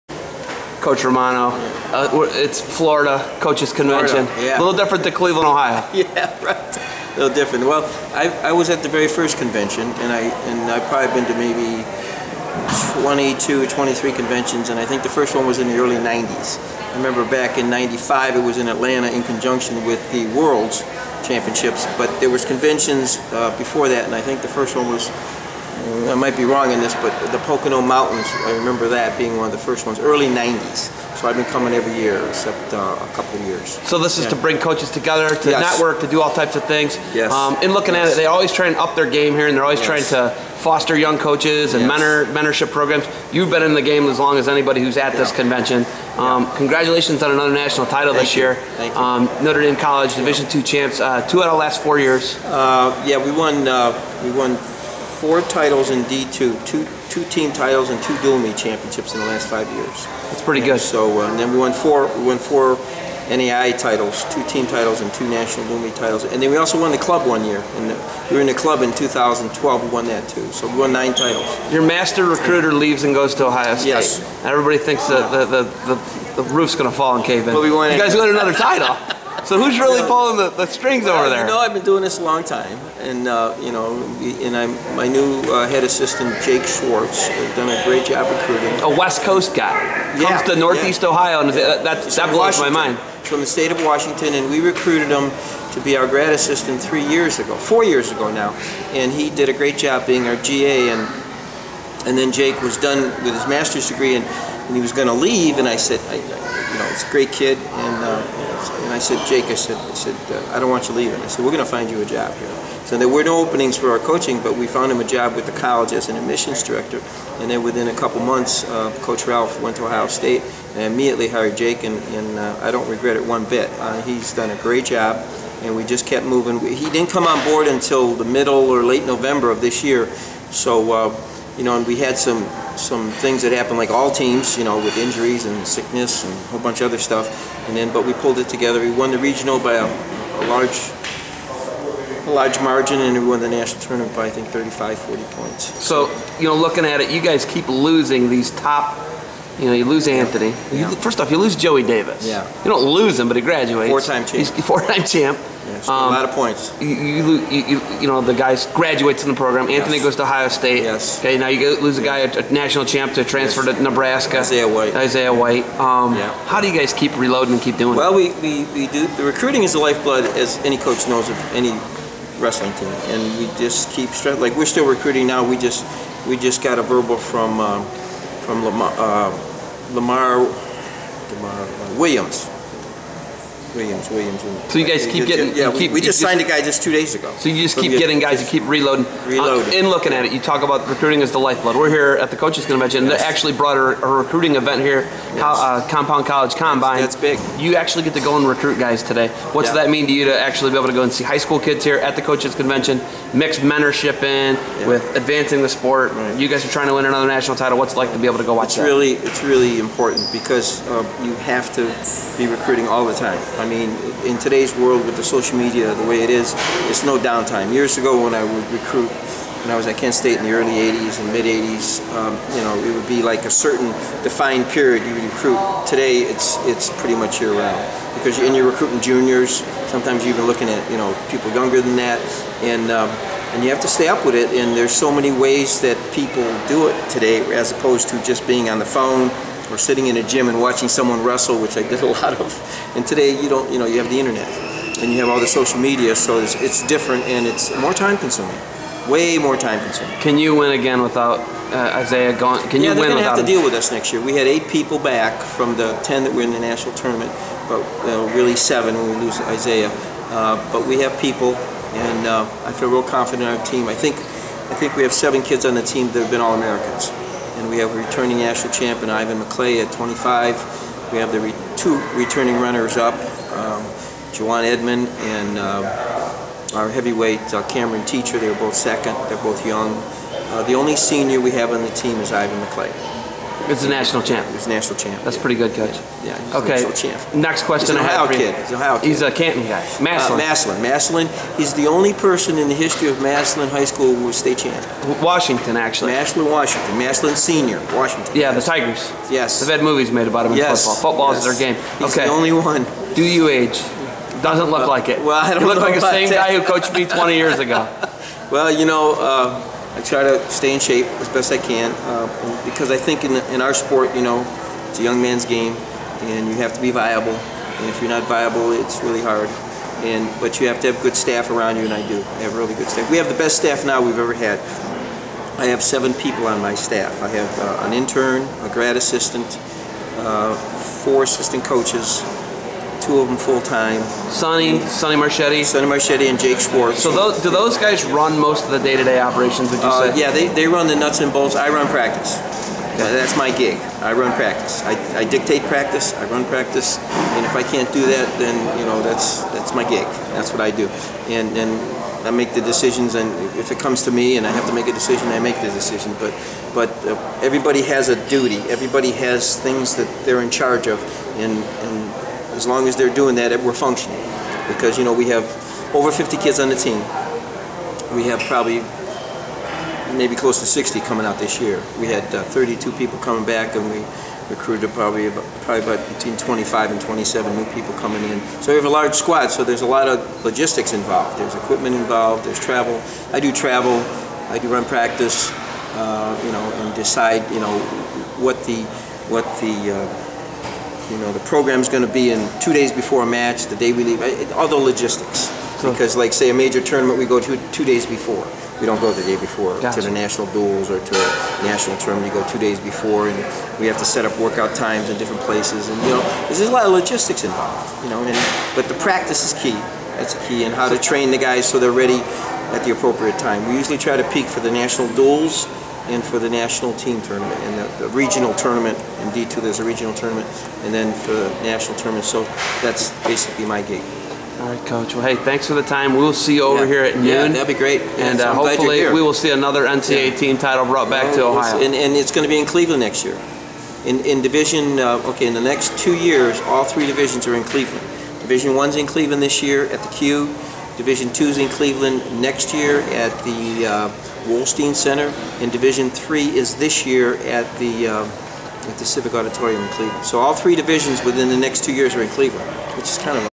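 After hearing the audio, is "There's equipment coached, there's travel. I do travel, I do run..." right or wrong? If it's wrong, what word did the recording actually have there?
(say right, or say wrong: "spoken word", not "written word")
wrong: "involved", not "coached".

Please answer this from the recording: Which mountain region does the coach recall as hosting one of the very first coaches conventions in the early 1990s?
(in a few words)
Pocono Mountains.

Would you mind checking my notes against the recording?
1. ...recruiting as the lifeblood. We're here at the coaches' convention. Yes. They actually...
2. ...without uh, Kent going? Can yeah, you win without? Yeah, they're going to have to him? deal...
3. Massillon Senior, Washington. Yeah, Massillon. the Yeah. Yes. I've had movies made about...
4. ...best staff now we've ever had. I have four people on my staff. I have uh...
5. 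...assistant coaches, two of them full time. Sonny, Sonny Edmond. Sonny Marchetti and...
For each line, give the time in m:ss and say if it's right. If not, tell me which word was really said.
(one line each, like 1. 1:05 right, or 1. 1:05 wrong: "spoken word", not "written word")
1. 3:10 right
2. 4:11 wrong: "Isaiah", not "Kent"
3. 4:56 wrong: "Tigers", not "Yeah"
4. 5:23 wrong: "seven", not "four"
5. 5:31 wrong: "Marchetti", not "Edmond".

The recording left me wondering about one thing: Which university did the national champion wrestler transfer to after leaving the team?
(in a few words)
Nebraska.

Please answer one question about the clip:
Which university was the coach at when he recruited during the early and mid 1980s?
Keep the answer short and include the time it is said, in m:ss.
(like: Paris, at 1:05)
Kent State, at 3:39.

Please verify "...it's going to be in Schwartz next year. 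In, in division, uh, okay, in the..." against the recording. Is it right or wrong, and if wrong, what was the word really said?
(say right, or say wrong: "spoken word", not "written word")
wrong: "Cleveland", not "Schwartz".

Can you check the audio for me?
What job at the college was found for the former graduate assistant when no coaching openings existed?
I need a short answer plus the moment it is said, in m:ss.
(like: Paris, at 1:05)
admissions director, at 1:56.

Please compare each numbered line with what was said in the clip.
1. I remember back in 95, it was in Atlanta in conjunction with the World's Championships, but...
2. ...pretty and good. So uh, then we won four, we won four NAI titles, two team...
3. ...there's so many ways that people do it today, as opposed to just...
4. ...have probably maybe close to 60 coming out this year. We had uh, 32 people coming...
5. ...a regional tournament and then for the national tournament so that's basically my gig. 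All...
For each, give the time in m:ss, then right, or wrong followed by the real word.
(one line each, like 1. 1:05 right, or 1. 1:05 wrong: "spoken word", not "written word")
1. 0:16 right
2. 1:00 right
3. 3:54 right
4. 6:08 right
5. 6:59 right.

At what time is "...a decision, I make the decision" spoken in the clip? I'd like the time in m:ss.
5:54.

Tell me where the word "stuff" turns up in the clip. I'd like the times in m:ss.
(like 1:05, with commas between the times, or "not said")
2:16.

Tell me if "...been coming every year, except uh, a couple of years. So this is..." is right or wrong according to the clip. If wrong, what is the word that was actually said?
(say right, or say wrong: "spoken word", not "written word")
right.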